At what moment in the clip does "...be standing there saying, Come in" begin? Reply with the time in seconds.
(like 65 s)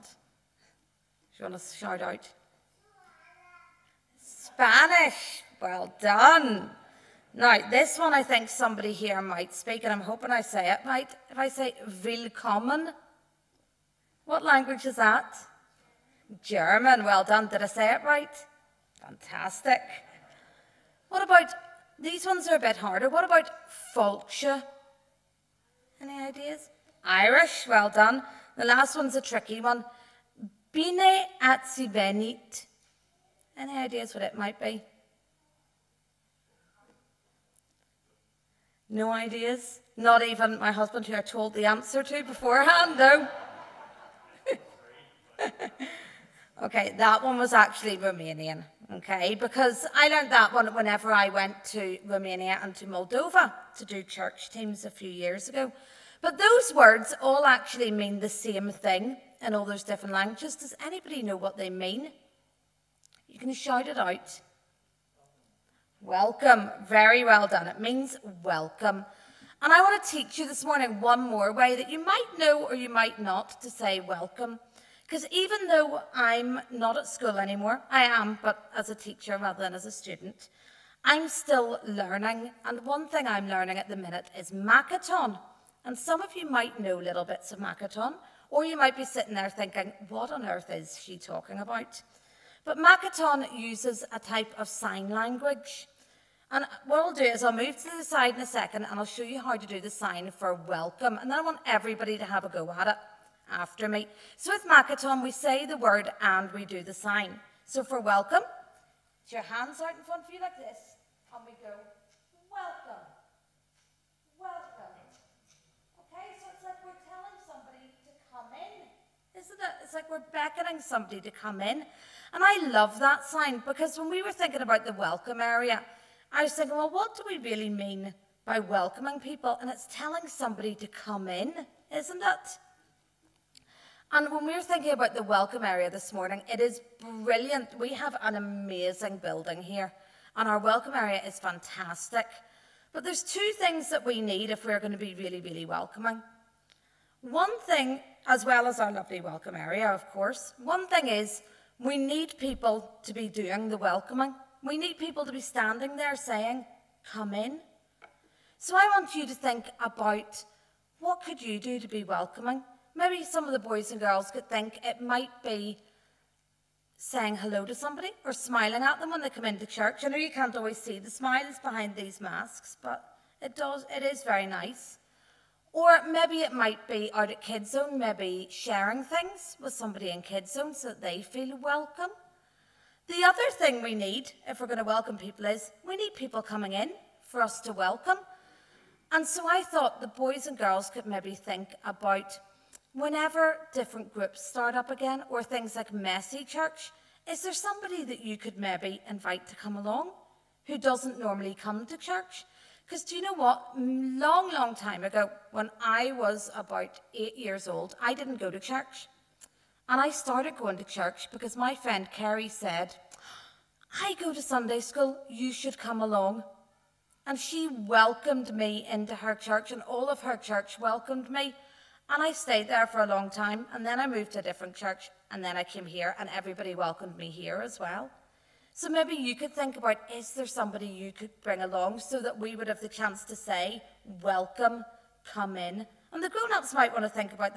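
155 s.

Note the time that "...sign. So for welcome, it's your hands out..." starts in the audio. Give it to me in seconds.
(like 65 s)
106 s.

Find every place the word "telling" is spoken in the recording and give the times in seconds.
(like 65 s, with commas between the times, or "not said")
117 s, 129 s.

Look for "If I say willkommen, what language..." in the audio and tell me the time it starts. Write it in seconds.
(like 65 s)
11 s.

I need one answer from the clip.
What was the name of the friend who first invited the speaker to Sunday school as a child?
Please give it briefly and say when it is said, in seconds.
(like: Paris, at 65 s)
Carrie, at 212 s.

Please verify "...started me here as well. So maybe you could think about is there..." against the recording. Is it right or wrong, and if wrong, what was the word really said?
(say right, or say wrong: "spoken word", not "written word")
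wrong: "welcomed", not "started".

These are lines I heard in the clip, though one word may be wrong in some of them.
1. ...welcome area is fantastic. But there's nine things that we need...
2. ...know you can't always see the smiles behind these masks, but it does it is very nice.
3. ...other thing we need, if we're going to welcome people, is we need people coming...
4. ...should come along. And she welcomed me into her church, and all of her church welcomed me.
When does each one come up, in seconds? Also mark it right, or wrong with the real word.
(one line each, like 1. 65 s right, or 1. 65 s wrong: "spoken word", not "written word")
1. 140 s wrong: "two", not "nine"
2. 170 s right
3. 183 s right
4. 215 s right.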